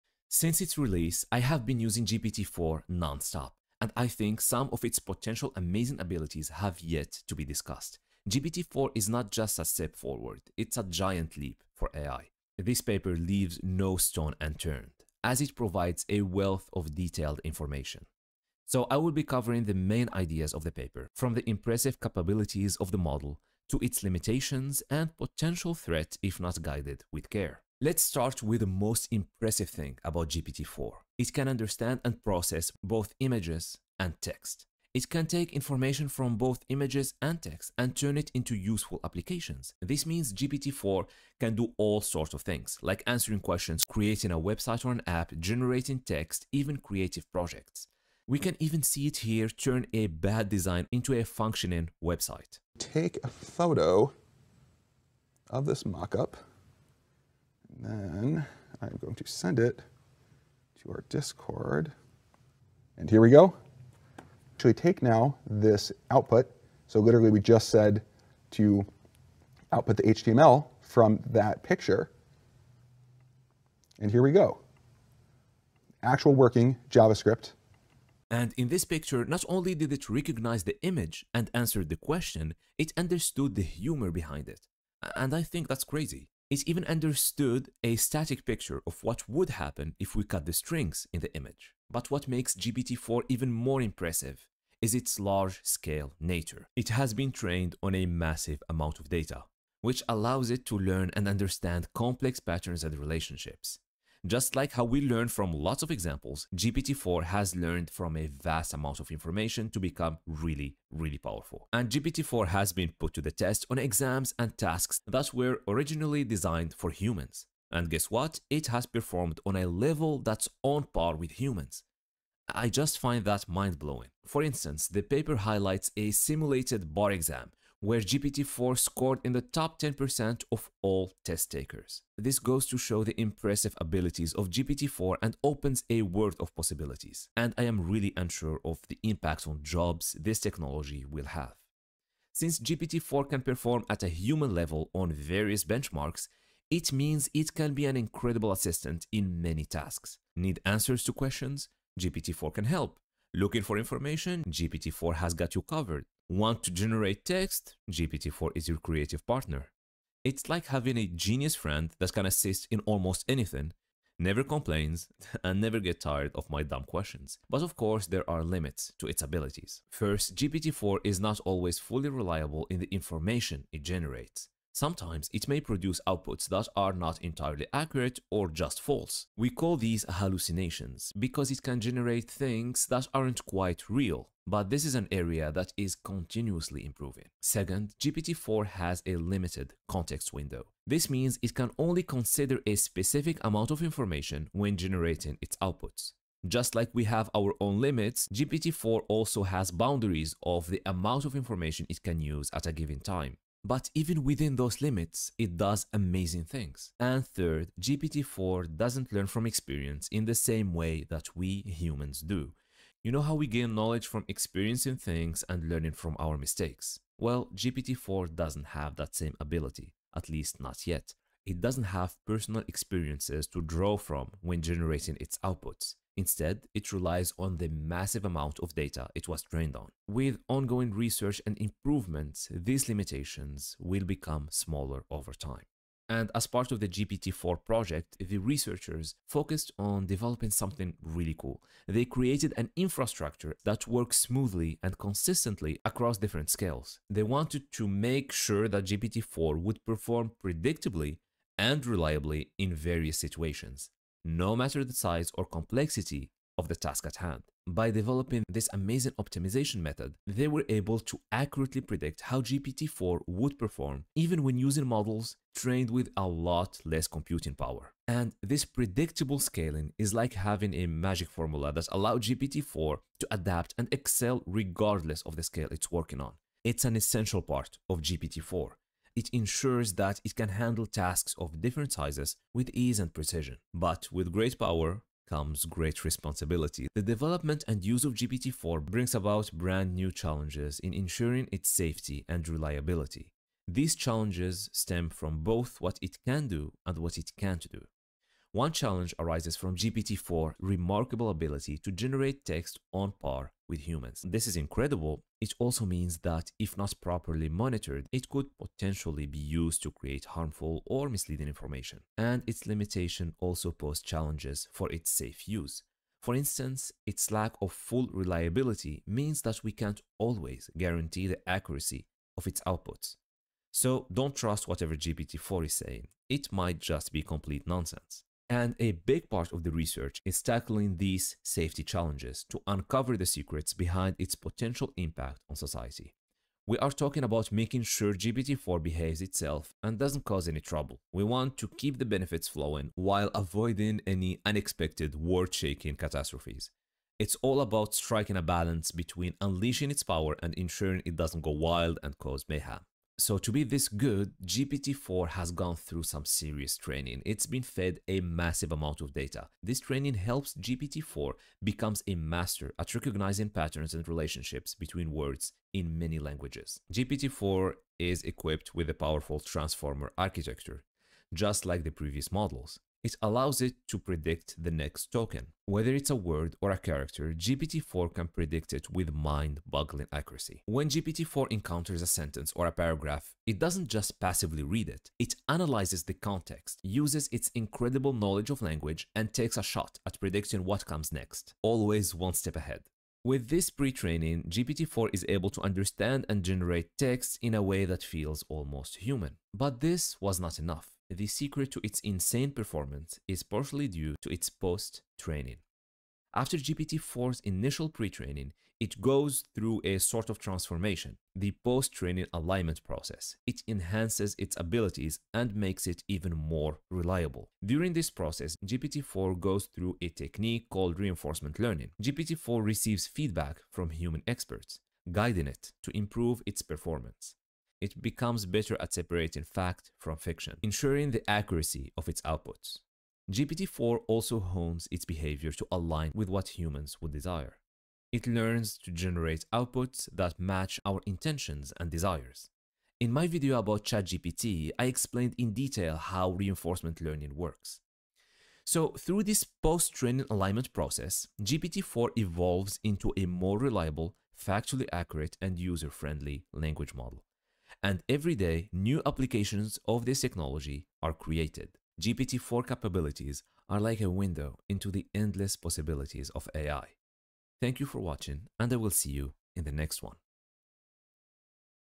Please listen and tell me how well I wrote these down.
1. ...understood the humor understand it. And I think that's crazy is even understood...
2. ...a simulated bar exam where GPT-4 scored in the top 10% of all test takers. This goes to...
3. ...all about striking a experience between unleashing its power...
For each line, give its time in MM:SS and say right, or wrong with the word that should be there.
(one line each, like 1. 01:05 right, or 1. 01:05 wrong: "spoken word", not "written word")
1. 01:22 wrong: "behind", not "understand"
2. 02:05 right
3. 05:47 wrong: "balance", not "experience".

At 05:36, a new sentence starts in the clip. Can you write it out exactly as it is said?
We are talking about making sure GPT-4 behaves itself and doesn't cause any trouble.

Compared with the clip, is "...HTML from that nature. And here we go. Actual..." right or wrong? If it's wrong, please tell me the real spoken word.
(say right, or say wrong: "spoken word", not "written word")
wrong: "picture", not "nature".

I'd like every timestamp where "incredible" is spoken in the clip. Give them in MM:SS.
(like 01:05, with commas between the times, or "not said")
02:27, 05:04, 06:27.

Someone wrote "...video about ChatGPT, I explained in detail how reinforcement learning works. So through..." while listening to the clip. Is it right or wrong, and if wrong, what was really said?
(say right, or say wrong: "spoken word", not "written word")
right.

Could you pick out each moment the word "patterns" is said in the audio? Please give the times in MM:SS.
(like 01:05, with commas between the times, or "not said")
01:42, 06:03.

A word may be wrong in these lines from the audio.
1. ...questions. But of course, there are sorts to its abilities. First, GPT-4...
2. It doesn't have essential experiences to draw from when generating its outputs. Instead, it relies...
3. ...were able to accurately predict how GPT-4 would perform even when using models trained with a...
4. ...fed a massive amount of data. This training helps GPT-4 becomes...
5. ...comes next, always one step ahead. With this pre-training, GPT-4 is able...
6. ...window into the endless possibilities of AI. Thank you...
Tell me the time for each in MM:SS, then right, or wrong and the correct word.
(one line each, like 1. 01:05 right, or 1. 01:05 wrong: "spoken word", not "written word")
1. 02:46 wrong: "limits", not "sorts"
2. 03:41 wrong: "personal", not "essential"
3. 04:20 right
4. 05:57 right
5. 06:30 right
6. 07:44 right.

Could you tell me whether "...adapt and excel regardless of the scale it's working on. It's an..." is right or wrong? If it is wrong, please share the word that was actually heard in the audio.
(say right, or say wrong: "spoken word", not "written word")
right.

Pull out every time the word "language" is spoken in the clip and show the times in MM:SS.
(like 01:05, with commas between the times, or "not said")
06:06, 06:28, 07:36.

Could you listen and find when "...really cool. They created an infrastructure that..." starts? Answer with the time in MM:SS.
04:01.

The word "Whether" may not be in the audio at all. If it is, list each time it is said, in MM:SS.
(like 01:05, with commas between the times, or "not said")
06:15.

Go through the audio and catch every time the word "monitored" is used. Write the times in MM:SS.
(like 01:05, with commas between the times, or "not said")
05:07.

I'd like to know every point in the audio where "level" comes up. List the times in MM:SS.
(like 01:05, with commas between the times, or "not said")
01:59, 02:24.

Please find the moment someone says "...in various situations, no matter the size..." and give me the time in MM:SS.
04:12.